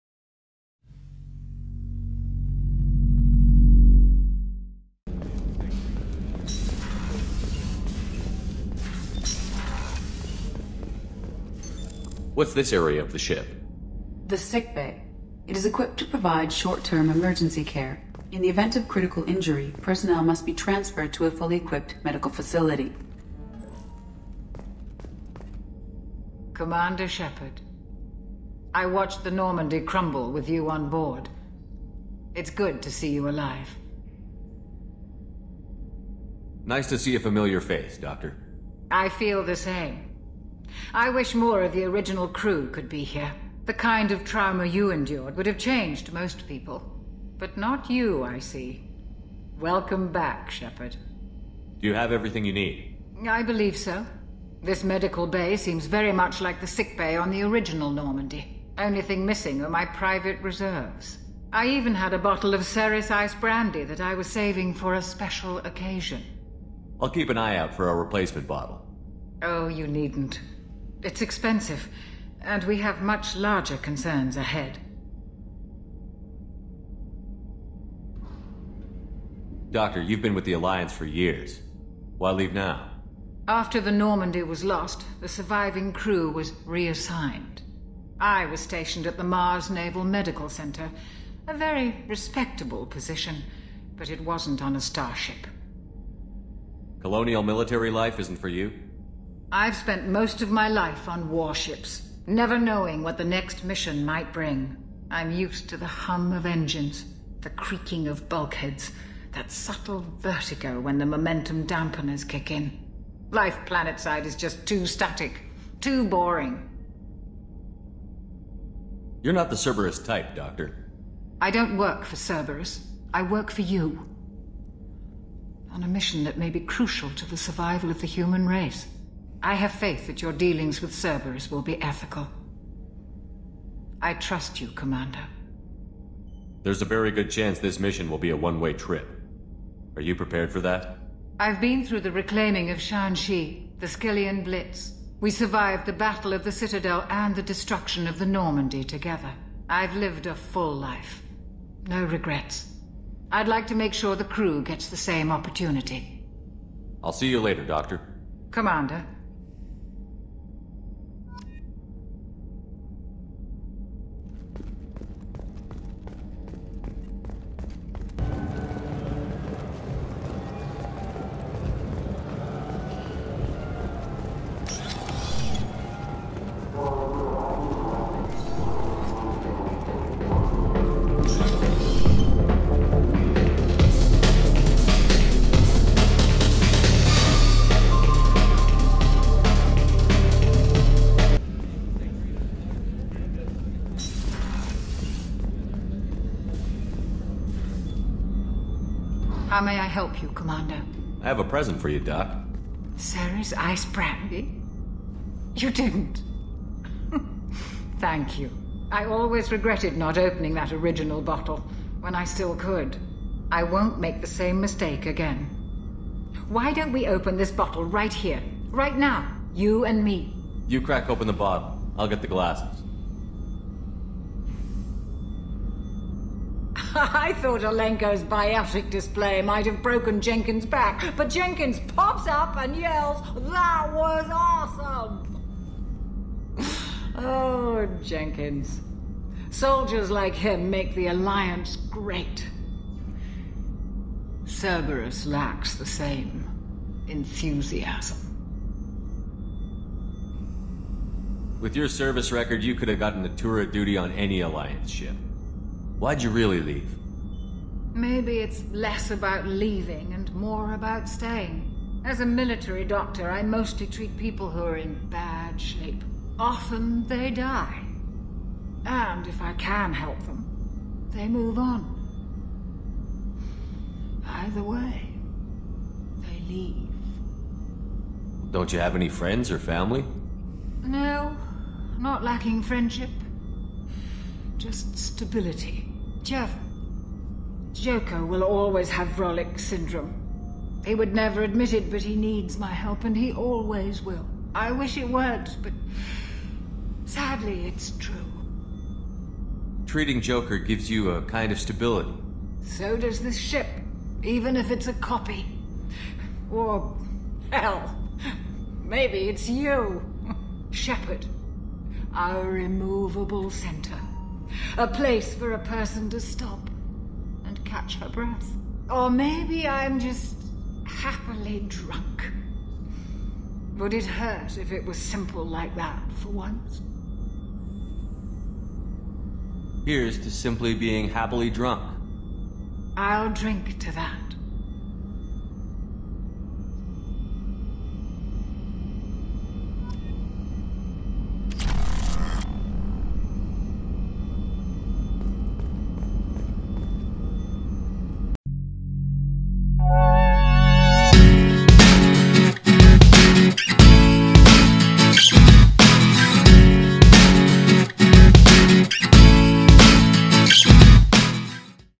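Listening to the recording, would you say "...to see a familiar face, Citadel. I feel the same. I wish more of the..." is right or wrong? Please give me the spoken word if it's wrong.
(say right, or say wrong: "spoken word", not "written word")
wrong: "Doctor", not "Citadel".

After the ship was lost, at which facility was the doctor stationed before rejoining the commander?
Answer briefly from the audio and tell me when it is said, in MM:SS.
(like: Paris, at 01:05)
Mars Naval Medical Center, at 01:29.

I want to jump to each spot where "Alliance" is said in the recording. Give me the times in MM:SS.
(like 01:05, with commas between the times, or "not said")
01:20, 04:01, 04:14.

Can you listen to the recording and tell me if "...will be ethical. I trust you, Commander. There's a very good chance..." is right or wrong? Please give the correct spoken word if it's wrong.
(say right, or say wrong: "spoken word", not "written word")
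right.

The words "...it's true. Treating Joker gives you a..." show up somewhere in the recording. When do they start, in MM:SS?
04:57.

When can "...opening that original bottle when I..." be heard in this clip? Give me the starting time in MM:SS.
03:30.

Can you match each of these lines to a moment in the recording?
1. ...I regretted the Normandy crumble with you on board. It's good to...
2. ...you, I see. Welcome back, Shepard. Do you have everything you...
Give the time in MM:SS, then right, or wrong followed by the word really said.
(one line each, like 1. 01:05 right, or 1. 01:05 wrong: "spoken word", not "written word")
1. 00:28 wrong: "watched", not "regretted"
2. 00:47 right.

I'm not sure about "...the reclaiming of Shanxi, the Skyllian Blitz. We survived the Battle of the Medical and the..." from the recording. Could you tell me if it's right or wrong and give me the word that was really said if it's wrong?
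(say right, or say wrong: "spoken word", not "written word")
wrong: "Citadel", not "Medical".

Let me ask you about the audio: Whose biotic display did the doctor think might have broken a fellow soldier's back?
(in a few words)
Alenko.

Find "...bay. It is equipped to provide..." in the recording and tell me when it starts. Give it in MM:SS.
00:14.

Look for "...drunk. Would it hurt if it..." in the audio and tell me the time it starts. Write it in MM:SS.
05:21.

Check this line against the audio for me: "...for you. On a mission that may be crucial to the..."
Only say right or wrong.
right.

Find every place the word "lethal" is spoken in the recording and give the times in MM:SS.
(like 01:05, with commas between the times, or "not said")
not said.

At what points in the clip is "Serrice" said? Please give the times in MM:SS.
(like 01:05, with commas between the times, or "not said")
01:02, 03:22.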